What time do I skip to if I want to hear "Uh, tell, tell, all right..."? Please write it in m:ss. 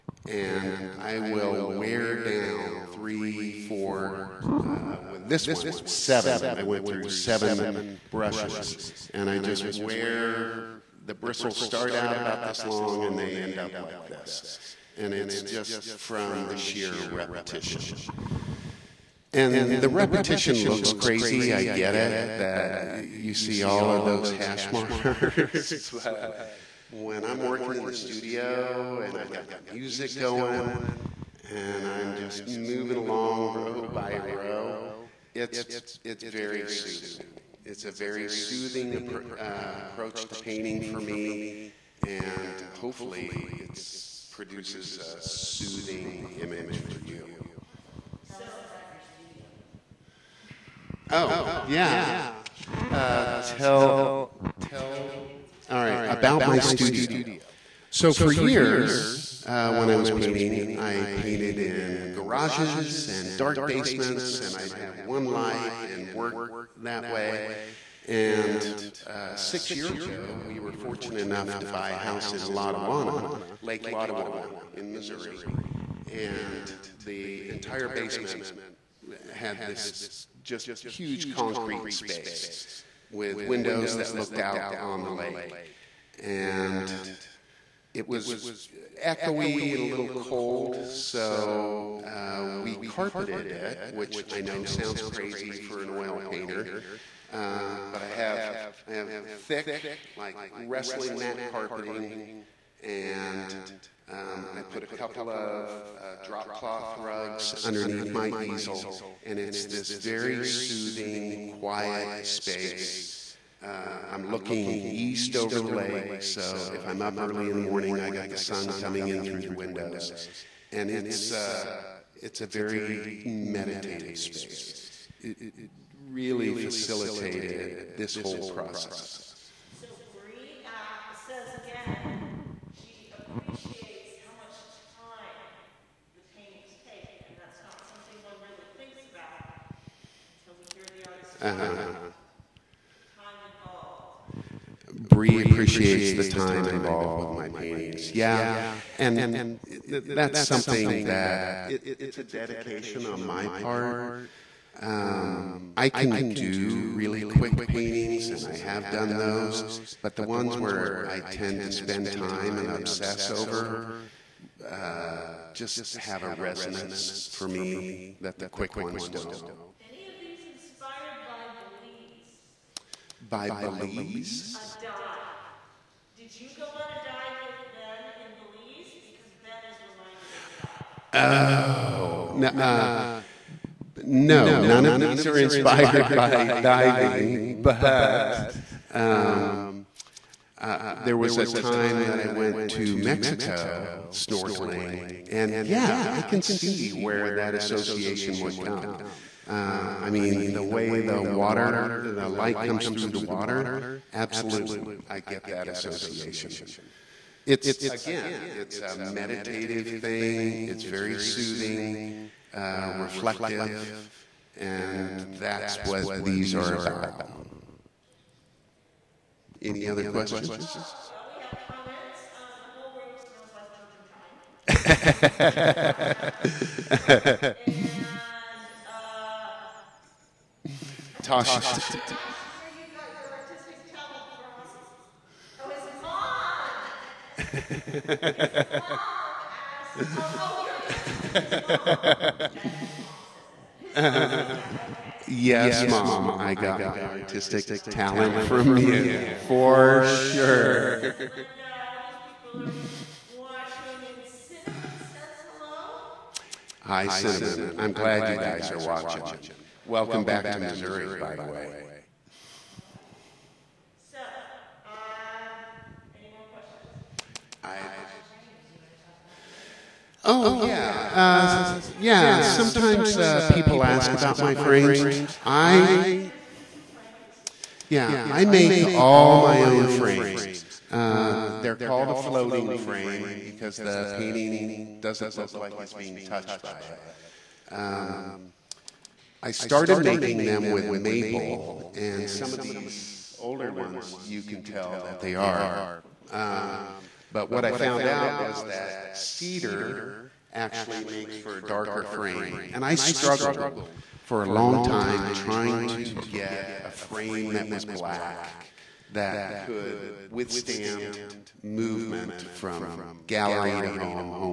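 0:52.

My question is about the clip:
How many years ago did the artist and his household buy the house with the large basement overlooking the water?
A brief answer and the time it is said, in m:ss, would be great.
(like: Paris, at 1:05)
6, at 1:09.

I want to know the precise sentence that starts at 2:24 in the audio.
Bree appreciates the time involved with my paintings.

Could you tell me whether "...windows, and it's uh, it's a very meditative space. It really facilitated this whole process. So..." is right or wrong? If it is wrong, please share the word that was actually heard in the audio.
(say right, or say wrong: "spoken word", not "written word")
right.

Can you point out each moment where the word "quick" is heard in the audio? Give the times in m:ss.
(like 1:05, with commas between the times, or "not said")
2:37, 2:48.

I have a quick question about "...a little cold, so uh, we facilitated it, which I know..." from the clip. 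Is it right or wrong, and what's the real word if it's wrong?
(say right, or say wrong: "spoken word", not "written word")
wrong: "carpeted", not "facilitated".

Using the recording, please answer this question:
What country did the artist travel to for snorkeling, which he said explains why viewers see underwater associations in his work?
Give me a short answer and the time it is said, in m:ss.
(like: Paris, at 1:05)
Mexico, at 3:12.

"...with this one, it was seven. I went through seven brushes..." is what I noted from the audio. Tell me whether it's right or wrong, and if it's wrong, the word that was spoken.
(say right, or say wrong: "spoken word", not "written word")
right.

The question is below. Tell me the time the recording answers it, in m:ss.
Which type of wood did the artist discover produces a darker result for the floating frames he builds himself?
4:59.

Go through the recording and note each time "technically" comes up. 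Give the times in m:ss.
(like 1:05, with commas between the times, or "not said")
not said.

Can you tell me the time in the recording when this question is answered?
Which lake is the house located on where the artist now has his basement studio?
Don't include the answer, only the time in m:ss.
1:13.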